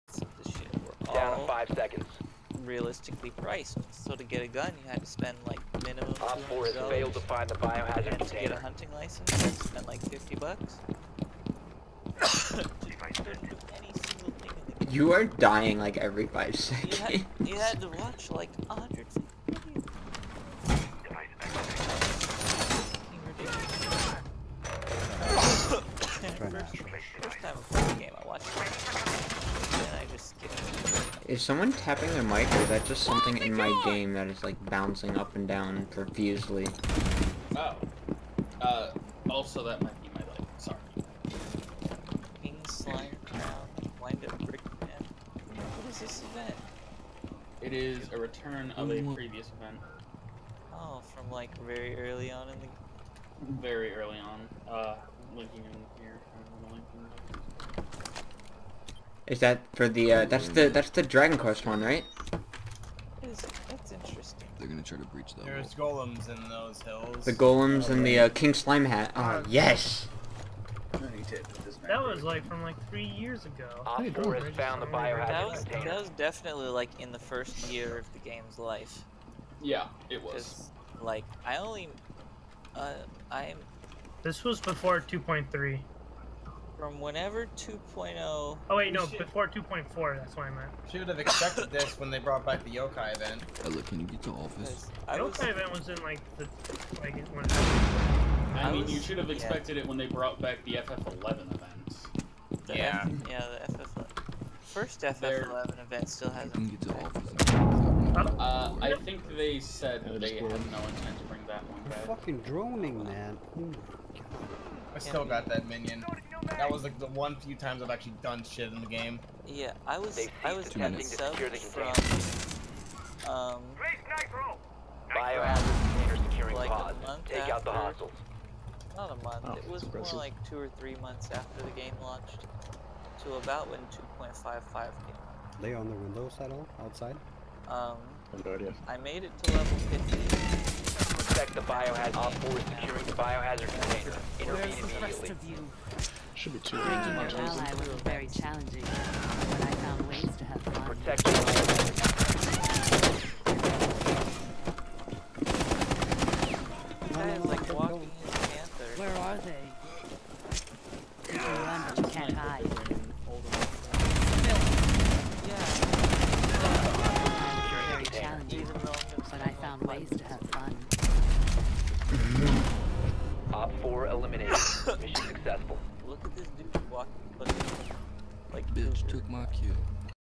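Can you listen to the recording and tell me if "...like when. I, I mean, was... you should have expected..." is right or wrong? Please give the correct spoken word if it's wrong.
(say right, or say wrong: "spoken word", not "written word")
right.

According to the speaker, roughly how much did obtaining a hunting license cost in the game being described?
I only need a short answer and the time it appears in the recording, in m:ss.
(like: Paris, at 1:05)
$50, at 0:10.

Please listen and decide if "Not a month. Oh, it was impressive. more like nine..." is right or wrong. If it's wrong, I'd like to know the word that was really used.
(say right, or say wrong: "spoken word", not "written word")
wrong: "two", not "nine".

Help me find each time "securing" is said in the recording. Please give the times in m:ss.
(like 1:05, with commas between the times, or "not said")
2:06, 2:22.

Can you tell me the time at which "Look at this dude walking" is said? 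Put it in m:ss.
2:56.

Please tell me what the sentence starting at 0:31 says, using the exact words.
Is someone tapping their mic, or is that just something in my game that is, like, bouncing up and down profusely?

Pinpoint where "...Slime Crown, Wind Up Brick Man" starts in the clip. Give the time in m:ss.
0:42.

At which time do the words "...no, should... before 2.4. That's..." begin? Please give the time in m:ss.
1:28.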